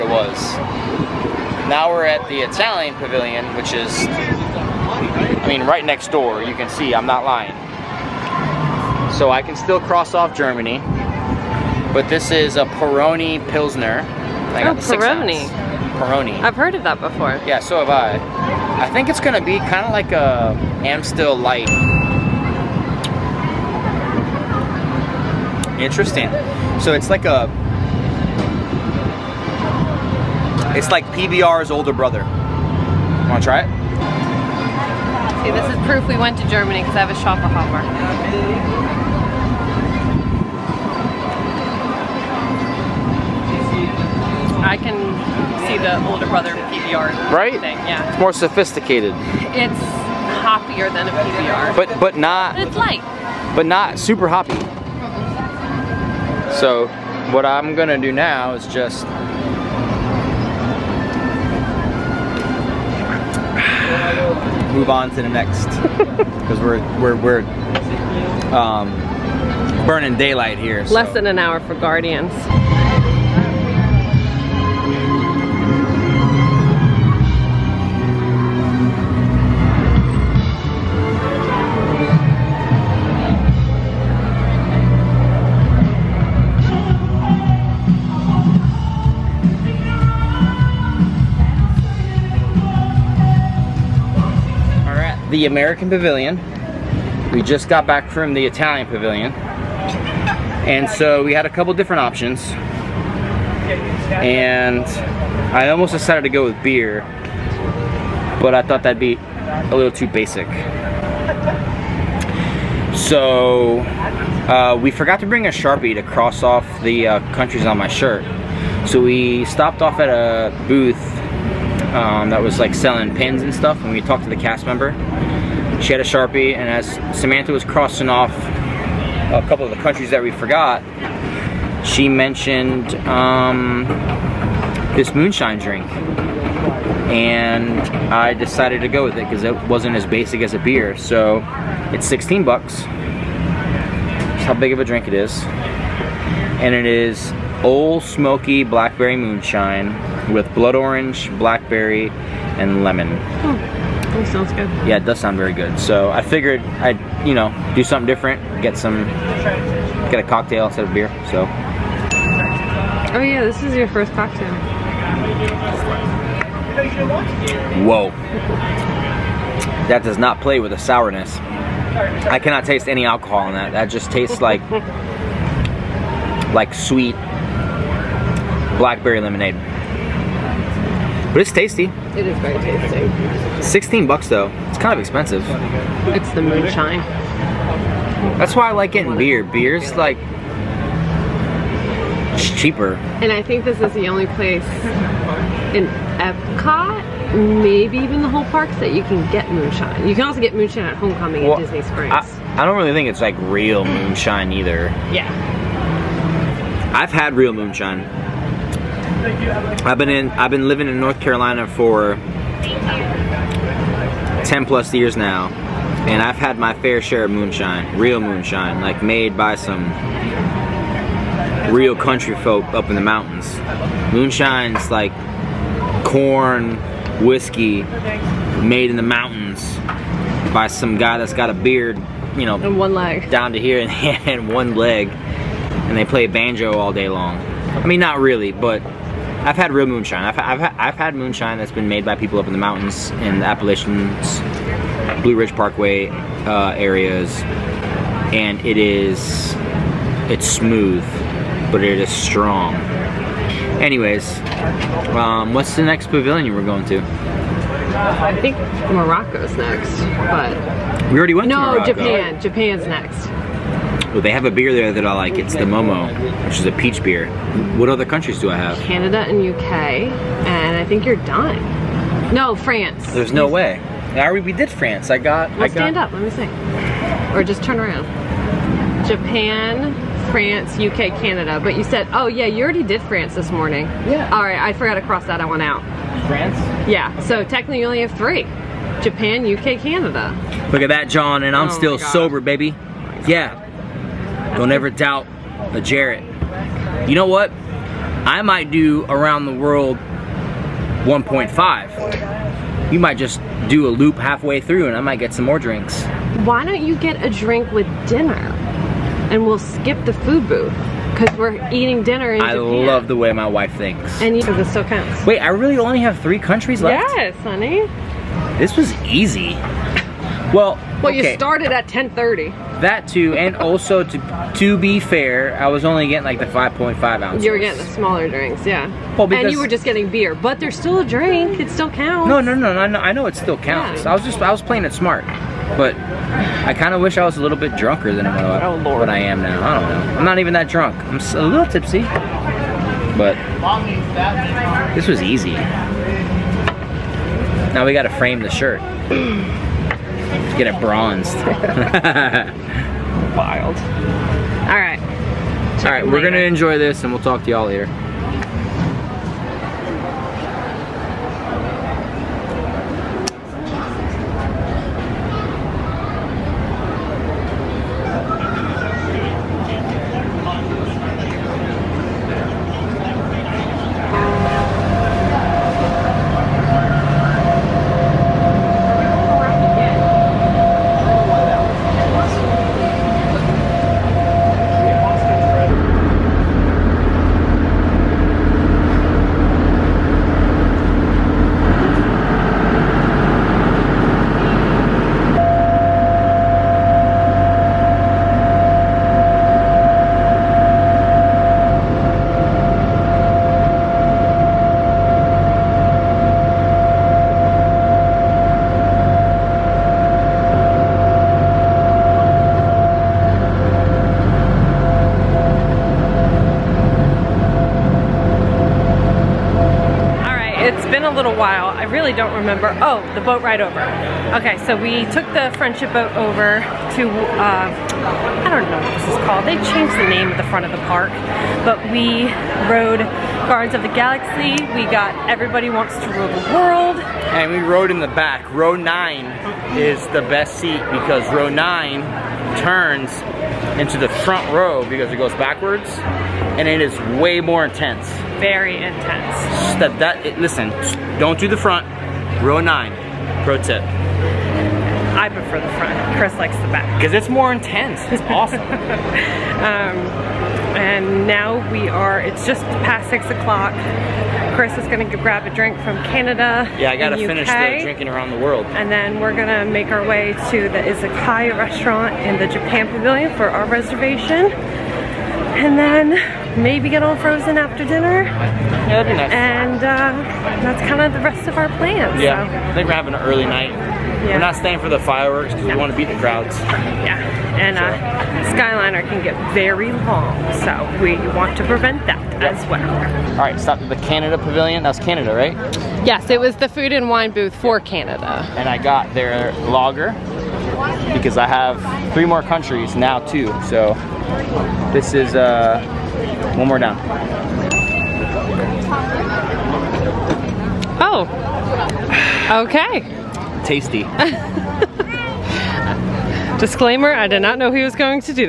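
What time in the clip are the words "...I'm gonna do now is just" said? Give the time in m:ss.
0:57.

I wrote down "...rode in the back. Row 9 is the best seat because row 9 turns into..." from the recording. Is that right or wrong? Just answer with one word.
right.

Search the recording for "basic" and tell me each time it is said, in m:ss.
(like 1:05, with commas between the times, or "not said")
1:50, 2:20.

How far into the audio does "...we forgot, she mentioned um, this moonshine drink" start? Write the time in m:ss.
2:10.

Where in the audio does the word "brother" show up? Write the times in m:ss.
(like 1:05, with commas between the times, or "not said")
0:31.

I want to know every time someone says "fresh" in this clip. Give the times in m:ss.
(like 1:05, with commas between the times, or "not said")
not said.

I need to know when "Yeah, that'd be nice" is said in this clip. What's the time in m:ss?
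7:58.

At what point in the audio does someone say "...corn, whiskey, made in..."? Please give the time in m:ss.
3:46.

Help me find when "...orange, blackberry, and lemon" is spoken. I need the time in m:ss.
2:30.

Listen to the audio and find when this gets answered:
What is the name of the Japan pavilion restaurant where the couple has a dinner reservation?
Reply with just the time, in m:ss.
7:50.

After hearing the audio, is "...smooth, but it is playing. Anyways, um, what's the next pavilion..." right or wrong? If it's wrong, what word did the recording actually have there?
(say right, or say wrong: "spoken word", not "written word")
wrong: "strong", not "playing".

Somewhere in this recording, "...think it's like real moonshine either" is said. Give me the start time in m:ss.
3:22.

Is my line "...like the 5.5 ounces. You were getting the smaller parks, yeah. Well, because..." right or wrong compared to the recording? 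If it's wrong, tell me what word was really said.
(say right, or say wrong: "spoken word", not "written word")
wrong: "drinks", not "parks".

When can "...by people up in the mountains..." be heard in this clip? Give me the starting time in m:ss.
4:02.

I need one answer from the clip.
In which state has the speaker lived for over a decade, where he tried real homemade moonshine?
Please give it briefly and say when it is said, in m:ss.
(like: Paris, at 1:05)
North Carolina, at 3:30.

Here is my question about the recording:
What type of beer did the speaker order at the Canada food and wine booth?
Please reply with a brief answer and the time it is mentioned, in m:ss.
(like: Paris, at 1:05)
Lager, at 8:19.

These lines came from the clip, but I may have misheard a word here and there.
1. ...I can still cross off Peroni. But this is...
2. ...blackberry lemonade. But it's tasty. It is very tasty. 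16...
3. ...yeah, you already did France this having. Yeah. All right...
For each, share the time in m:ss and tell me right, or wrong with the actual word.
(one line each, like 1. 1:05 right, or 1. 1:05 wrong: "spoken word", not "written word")
1. 0:09 wrong: "Germany", not "Peroni"
2. 2:58 right
3. 4:42 wrong: "morning", not "having".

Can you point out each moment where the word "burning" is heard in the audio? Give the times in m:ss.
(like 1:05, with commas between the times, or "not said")
1:09.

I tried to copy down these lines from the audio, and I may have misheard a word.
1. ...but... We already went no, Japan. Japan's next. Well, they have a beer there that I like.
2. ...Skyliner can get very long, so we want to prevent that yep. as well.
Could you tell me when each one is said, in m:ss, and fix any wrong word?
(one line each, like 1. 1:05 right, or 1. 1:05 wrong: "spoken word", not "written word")
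1. 4:20 right
2. 8:08 right.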